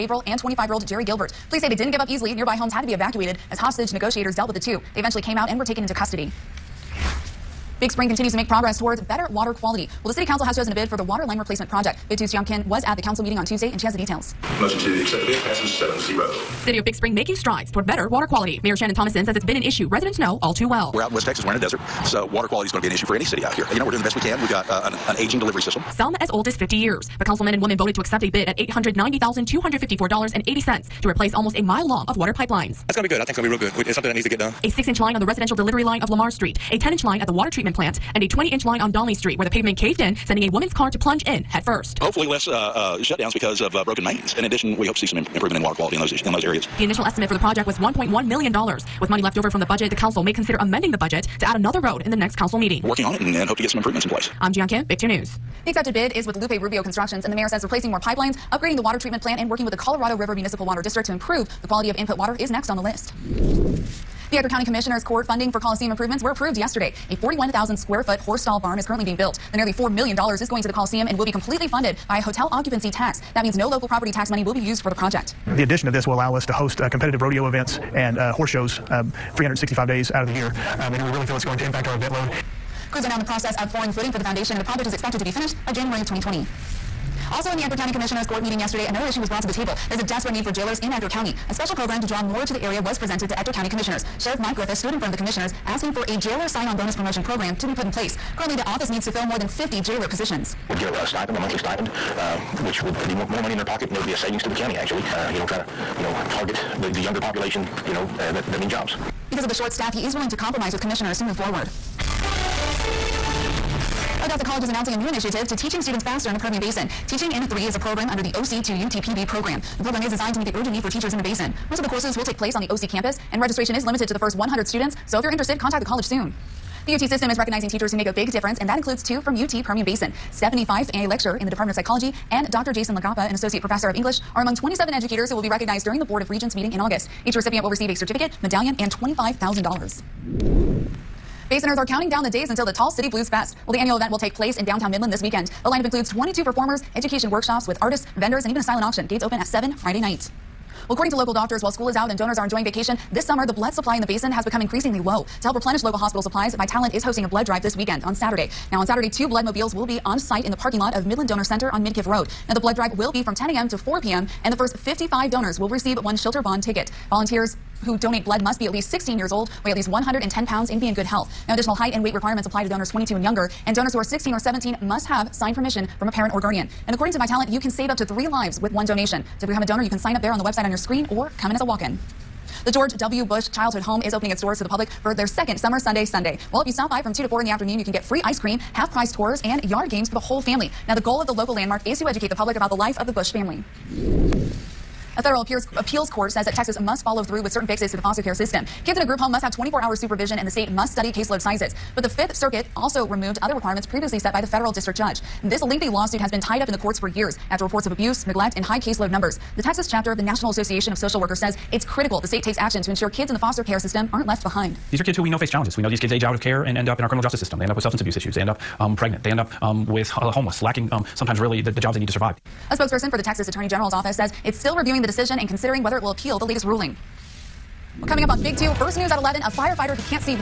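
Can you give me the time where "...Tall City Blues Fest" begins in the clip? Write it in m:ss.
2:22.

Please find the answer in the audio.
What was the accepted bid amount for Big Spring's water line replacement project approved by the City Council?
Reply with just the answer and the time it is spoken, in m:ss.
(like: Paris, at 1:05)
$890,254.80, at 0:28.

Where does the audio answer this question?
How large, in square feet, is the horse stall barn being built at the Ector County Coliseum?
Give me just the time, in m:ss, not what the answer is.
1:07.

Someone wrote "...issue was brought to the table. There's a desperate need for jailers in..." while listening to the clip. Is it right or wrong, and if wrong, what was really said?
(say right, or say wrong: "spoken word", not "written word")
right.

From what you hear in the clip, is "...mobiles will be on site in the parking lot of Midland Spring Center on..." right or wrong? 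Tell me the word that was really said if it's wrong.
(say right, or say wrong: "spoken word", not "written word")
wrong: "Donor", not "Spring".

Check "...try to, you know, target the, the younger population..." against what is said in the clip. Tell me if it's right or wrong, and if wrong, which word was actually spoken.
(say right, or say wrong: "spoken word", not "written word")
right.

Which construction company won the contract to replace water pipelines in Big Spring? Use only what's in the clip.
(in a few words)
Lupe Rubio Constructions.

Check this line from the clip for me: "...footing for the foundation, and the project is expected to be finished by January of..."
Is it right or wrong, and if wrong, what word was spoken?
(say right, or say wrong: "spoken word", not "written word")
right.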